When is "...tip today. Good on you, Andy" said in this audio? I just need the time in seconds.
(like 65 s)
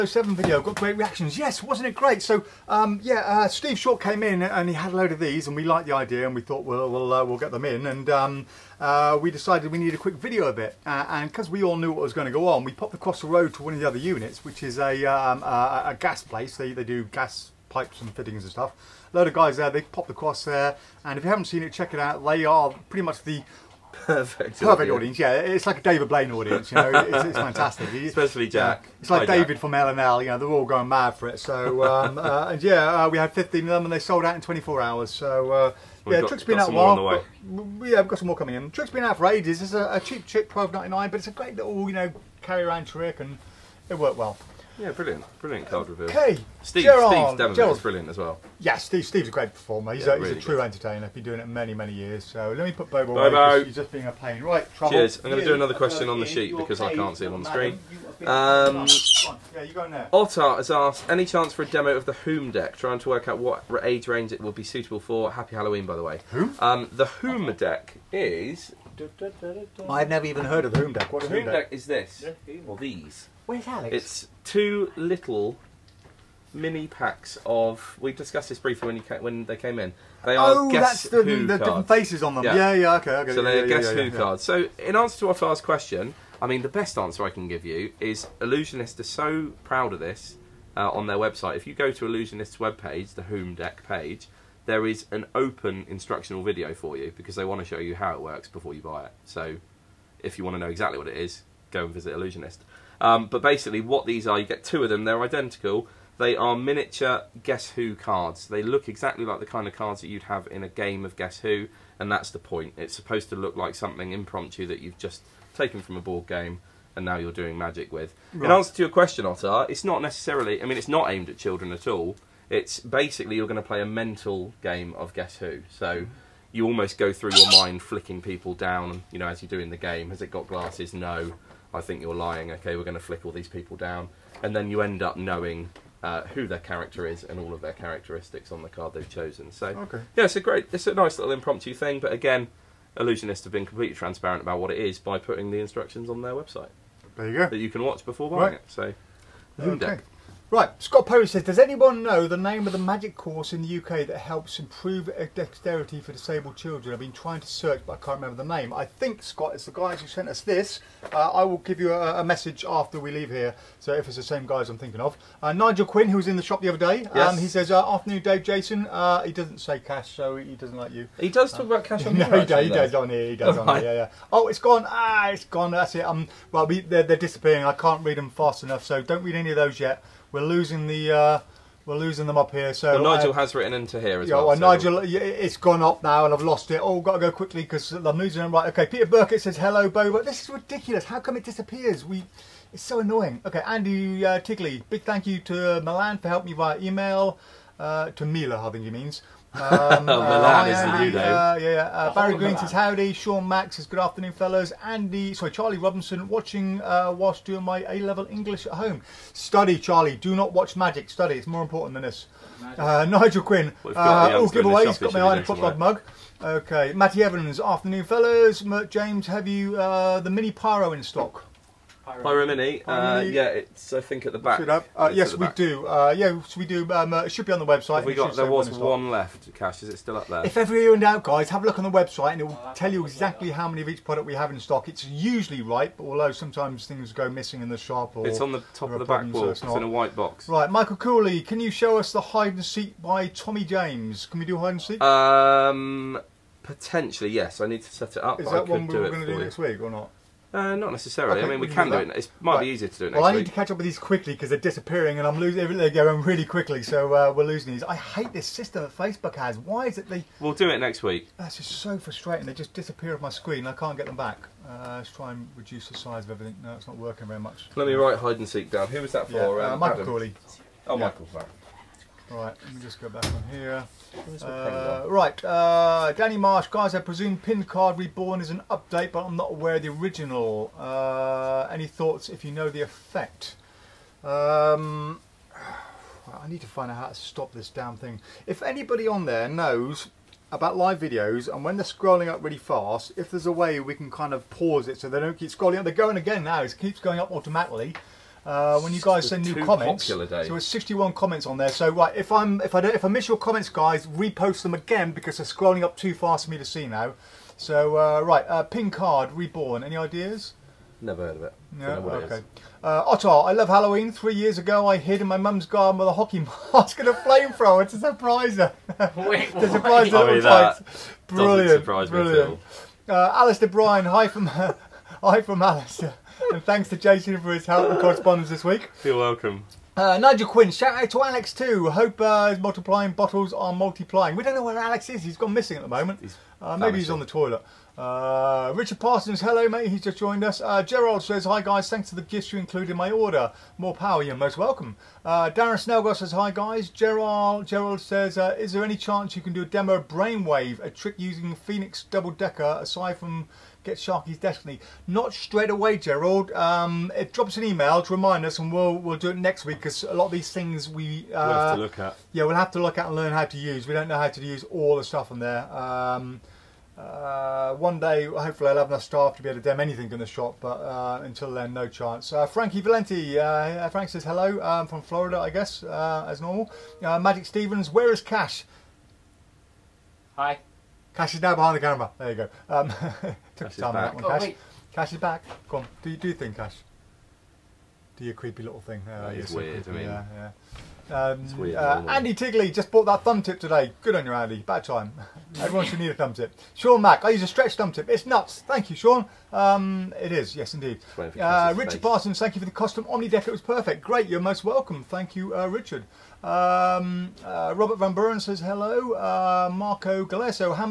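393 s.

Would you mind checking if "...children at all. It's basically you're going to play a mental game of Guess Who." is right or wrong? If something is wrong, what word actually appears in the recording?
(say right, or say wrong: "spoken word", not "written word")
right.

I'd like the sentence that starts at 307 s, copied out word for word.
So uh, right, uh, pin card reborn.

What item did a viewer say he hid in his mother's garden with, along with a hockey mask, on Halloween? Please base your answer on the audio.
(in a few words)
a flamethrower.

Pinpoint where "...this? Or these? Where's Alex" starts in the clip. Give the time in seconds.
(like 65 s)
71 s.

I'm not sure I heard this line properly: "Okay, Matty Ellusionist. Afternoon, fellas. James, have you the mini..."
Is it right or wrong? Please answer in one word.
wrong.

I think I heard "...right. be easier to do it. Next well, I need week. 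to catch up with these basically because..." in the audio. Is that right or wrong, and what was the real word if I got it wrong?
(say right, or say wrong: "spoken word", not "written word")
wrong: "quickly", not "basically".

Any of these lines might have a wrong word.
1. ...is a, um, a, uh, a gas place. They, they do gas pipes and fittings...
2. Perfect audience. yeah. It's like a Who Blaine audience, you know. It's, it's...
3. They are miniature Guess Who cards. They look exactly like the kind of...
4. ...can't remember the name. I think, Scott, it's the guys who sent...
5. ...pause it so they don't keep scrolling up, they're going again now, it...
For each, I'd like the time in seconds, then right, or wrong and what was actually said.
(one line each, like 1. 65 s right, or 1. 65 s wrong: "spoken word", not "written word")
1. 14 s right
2. 24 s wrong: "David", not "Who"
3. 106 s right
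4. 157 s right
5. 294 s right.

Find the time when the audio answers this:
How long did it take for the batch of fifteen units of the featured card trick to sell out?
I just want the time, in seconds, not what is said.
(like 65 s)
34 s.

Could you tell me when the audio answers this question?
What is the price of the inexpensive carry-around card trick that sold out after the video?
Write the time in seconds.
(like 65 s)
40 s.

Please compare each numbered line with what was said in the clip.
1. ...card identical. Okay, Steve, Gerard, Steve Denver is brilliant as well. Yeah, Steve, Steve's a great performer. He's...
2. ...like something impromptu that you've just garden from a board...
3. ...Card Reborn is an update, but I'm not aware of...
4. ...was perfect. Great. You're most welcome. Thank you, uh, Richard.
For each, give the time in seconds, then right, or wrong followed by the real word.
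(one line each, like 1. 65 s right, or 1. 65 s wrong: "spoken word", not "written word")
1. 45 s wrong: "reveal", not "identical"
2. 113 s wrong: "taken", not "garden"
3. 277 s right
4. 403 s right.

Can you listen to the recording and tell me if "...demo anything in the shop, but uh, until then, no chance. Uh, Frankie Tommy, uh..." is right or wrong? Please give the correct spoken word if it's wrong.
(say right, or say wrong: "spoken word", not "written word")
wrong: "Valenti", not "Tommy".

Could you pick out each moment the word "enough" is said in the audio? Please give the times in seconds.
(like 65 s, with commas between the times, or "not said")
178 s, 368 s.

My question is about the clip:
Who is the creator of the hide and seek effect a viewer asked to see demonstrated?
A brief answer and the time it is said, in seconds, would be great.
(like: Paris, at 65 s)
Tommy James, at 243 s.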